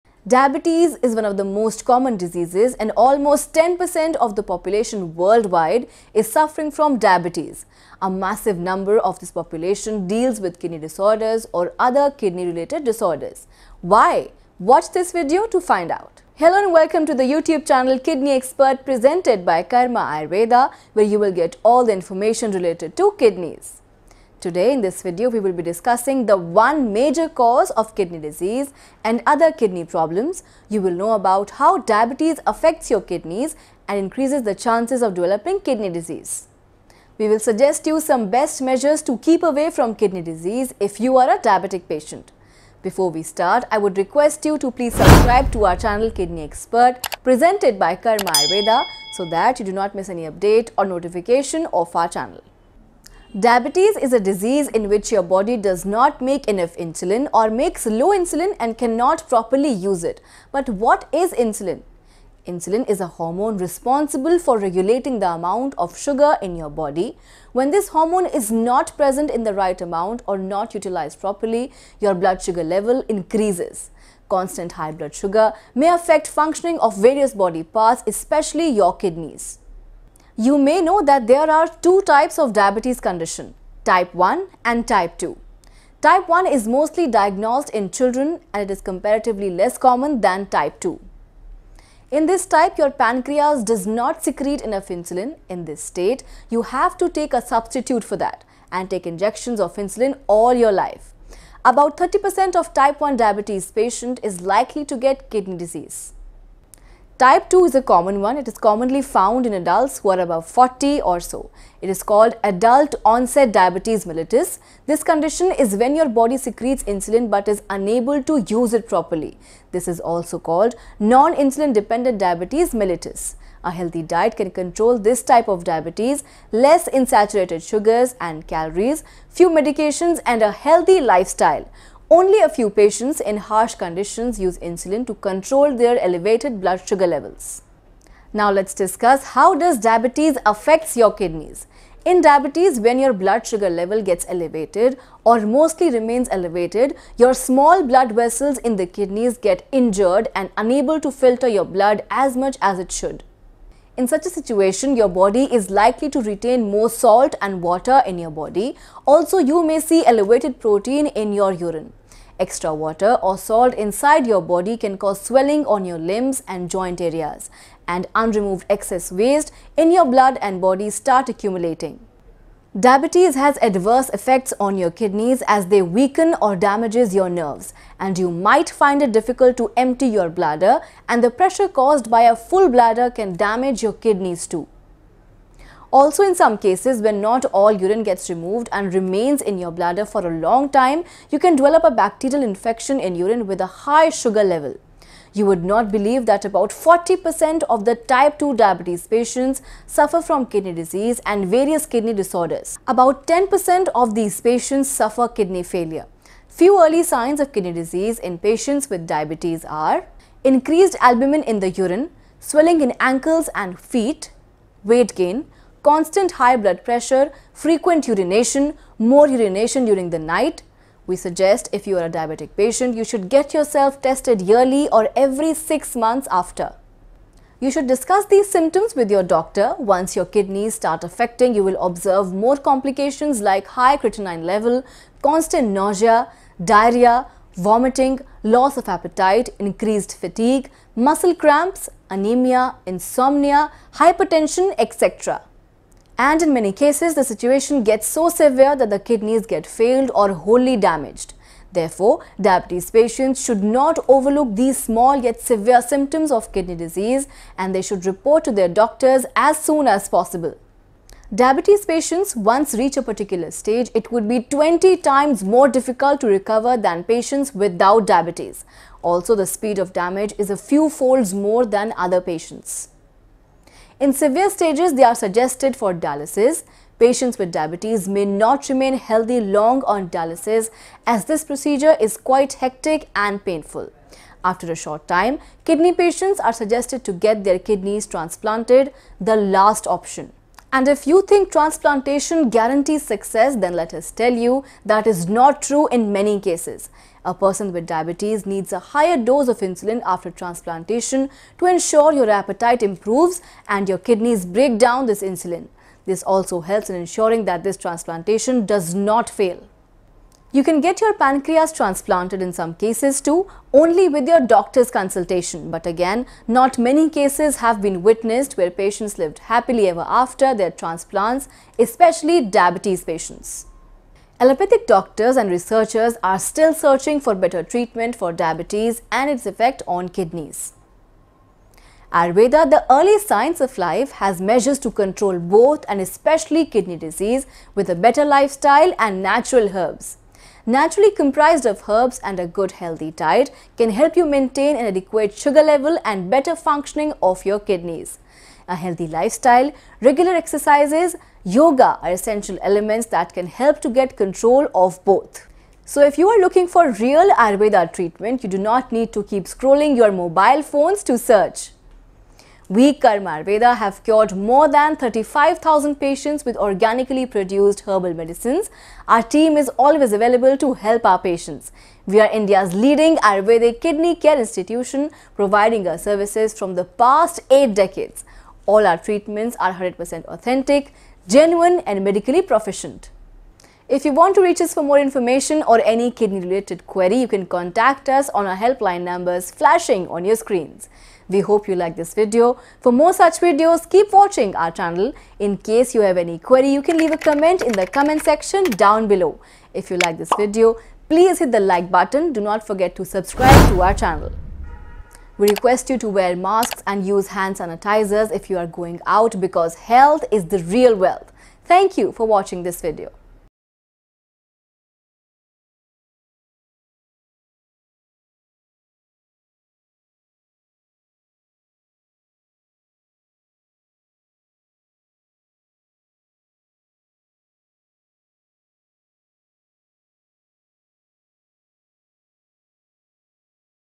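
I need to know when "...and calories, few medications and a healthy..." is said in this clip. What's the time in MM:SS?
02:08.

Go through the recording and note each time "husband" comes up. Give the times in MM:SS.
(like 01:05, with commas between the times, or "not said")
not said.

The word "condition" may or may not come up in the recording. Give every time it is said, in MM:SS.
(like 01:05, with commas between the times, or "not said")
01:22, 01:55, 02:13.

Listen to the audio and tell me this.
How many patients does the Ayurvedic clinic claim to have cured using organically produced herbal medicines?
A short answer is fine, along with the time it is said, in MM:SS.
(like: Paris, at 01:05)
35,000, at 06:04.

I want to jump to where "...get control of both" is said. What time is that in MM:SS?
05:53.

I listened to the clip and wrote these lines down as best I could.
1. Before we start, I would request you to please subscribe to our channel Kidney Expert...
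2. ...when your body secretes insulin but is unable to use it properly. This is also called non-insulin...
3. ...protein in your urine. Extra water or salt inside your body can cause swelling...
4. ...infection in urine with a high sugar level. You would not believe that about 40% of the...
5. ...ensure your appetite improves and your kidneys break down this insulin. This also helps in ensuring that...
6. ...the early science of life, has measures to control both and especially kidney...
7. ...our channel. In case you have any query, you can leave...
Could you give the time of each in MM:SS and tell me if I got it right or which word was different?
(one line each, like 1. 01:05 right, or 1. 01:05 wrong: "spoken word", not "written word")
1. 00:42 right
2. 01:55 right
3. 02:40 right
4. 03:12 right
5. 05:01 right
6. 05:32 right
7. 06:34 right.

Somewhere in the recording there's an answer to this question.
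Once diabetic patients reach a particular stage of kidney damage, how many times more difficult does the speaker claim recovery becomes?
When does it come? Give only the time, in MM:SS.
04:24.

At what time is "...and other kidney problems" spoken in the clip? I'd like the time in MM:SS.
00:29.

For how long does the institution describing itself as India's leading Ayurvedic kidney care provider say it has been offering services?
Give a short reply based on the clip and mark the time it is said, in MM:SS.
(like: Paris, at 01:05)
8 decades, at 06:17.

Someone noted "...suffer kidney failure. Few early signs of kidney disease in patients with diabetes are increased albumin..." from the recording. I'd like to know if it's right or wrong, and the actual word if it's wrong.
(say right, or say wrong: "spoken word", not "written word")
right.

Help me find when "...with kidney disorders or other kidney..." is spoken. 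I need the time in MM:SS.
00:10.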